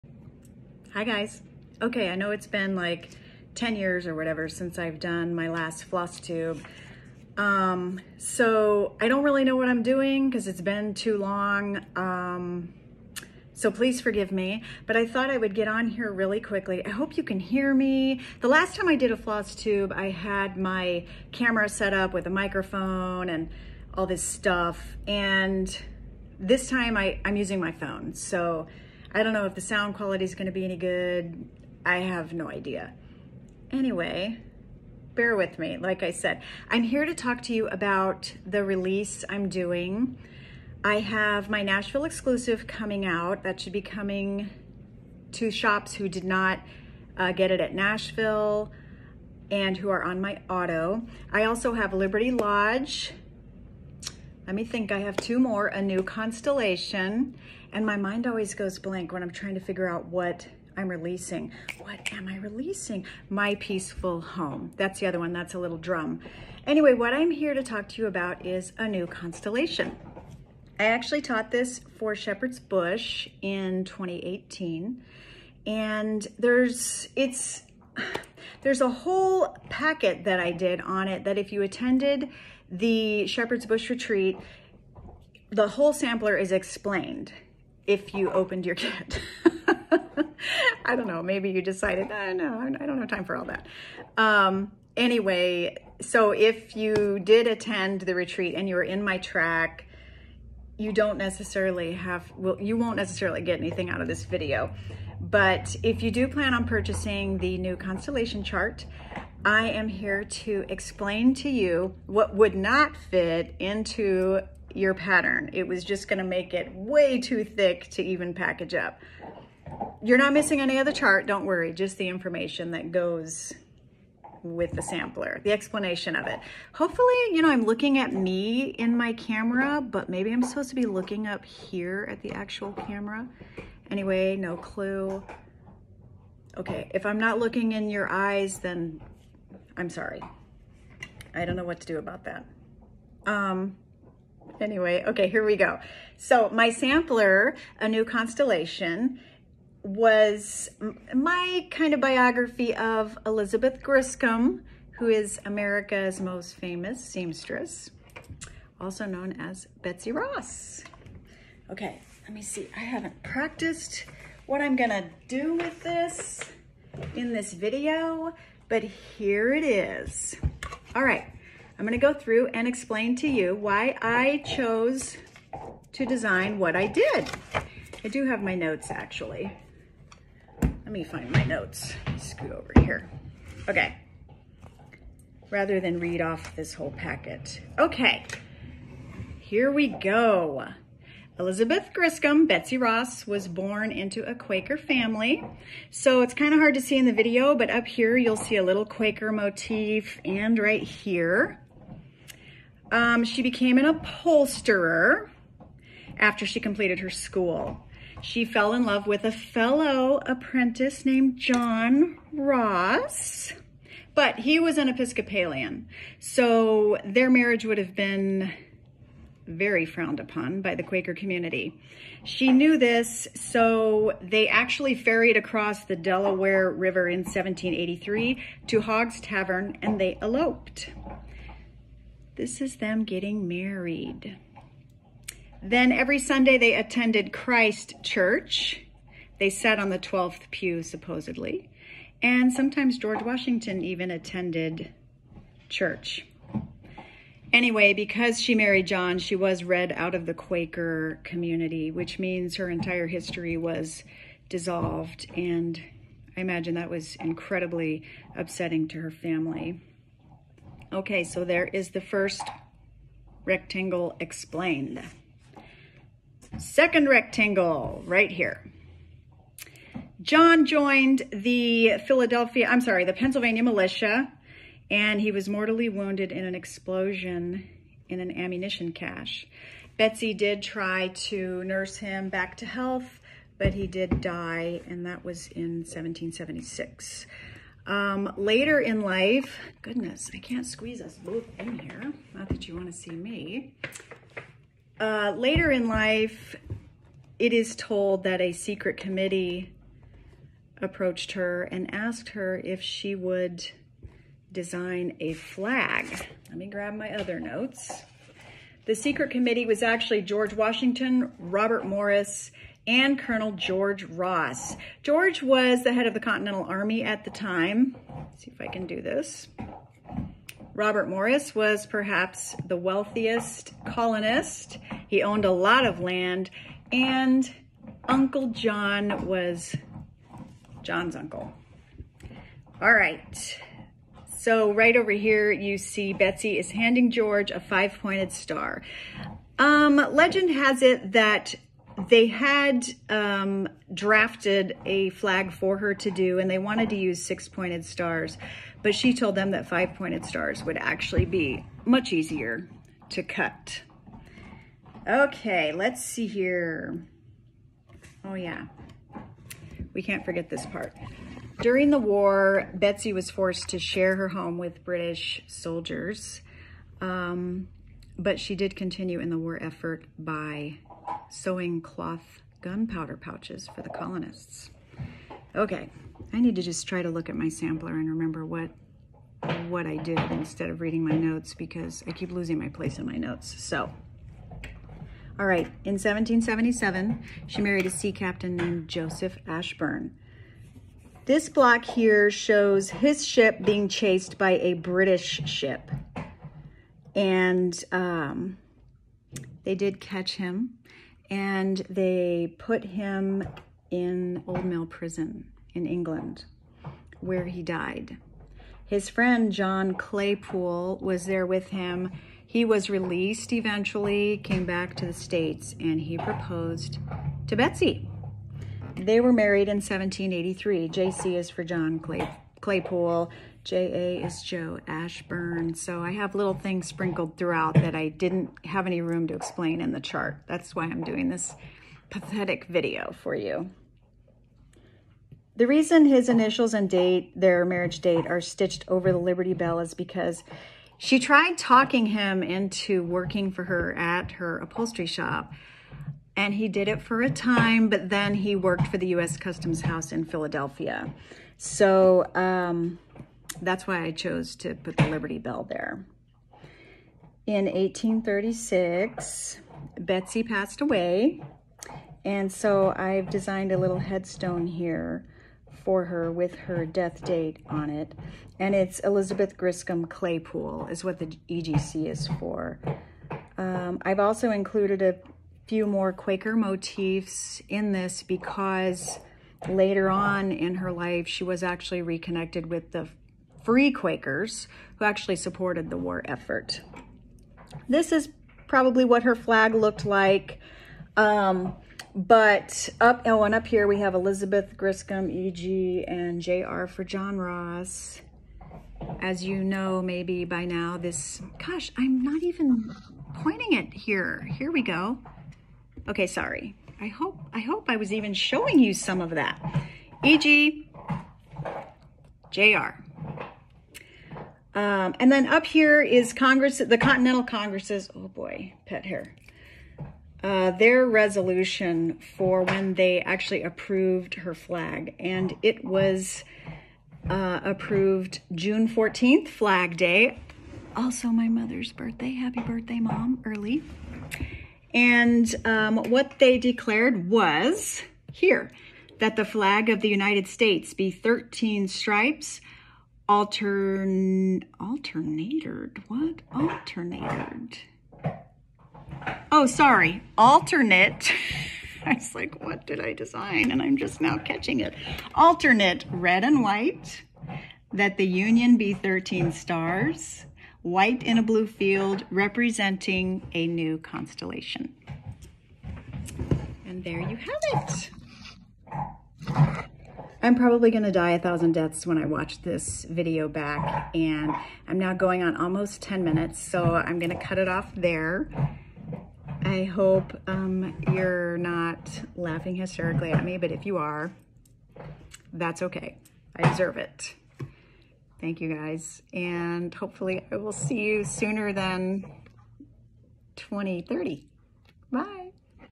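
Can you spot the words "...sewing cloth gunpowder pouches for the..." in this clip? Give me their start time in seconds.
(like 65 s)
371 s.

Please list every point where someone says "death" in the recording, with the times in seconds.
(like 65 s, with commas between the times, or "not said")
466 s, 571 s.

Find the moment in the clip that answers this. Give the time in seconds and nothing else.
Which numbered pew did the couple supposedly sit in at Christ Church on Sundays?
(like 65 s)
239 s.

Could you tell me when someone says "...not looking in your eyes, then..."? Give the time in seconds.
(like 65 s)
137 s.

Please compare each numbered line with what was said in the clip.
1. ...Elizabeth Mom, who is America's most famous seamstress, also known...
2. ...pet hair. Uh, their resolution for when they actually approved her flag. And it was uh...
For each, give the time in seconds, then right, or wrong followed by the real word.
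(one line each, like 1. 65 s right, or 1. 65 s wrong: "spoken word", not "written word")
1. 153 s wrong: "Griscom", not "Mom"
2. 518 s right.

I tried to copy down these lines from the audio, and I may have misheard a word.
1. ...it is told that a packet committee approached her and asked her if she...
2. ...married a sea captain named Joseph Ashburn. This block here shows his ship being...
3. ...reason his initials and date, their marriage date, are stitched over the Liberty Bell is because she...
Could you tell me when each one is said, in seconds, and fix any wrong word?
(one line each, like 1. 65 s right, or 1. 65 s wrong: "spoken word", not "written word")
1. 297 s wrong: "secret", not "packet"
2. 387 s right
3. 435 s right.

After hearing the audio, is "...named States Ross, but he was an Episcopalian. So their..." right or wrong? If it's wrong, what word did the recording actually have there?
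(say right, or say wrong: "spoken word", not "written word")
wrong: "John", not "States".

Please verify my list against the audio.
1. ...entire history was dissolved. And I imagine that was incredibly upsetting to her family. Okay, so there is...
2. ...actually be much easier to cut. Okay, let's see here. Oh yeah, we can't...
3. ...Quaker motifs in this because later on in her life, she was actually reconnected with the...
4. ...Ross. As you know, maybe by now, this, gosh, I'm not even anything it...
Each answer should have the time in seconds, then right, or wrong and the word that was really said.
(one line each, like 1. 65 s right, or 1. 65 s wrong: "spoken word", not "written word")
1. 252 s right
2. 350 s right
3. 476 s right
4. 497 s wrong: "pointing", not "anything".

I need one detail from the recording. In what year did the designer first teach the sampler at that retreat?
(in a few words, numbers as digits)
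2018.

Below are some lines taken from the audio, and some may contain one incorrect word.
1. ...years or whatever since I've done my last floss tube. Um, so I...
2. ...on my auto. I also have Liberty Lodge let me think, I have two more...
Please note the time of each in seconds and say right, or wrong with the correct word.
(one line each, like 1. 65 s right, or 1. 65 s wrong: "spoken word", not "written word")
1. 3 s right
2. 50 s right.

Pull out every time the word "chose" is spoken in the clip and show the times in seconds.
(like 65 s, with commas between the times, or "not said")
174 s, 454 s.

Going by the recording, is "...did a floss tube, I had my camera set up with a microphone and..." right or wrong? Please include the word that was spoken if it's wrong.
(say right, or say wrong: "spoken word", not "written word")
right.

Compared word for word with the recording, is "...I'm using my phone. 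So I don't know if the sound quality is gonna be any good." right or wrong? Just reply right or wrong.
right.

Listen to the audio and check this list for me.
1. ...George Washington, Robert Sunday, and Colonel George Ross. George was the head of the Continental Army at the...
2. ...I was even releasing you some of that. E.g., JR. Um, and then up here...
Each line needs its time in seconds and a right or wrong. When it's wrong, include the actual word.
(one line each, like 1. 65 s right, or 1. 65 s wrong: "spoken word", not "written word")
1. 310 s wrong: "Morris", not "Sunday"
2. 507 s wrong: "showing", not "releasing".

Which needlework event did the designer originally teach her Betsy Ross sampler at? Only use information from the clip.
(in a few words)
Shepherd's Bush Retreat.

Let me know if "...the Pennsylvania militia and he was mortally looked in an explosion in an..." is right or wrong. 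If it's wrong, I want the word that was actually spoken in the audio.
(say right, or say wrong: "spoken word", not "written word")
wrong: "wounded", not "looked".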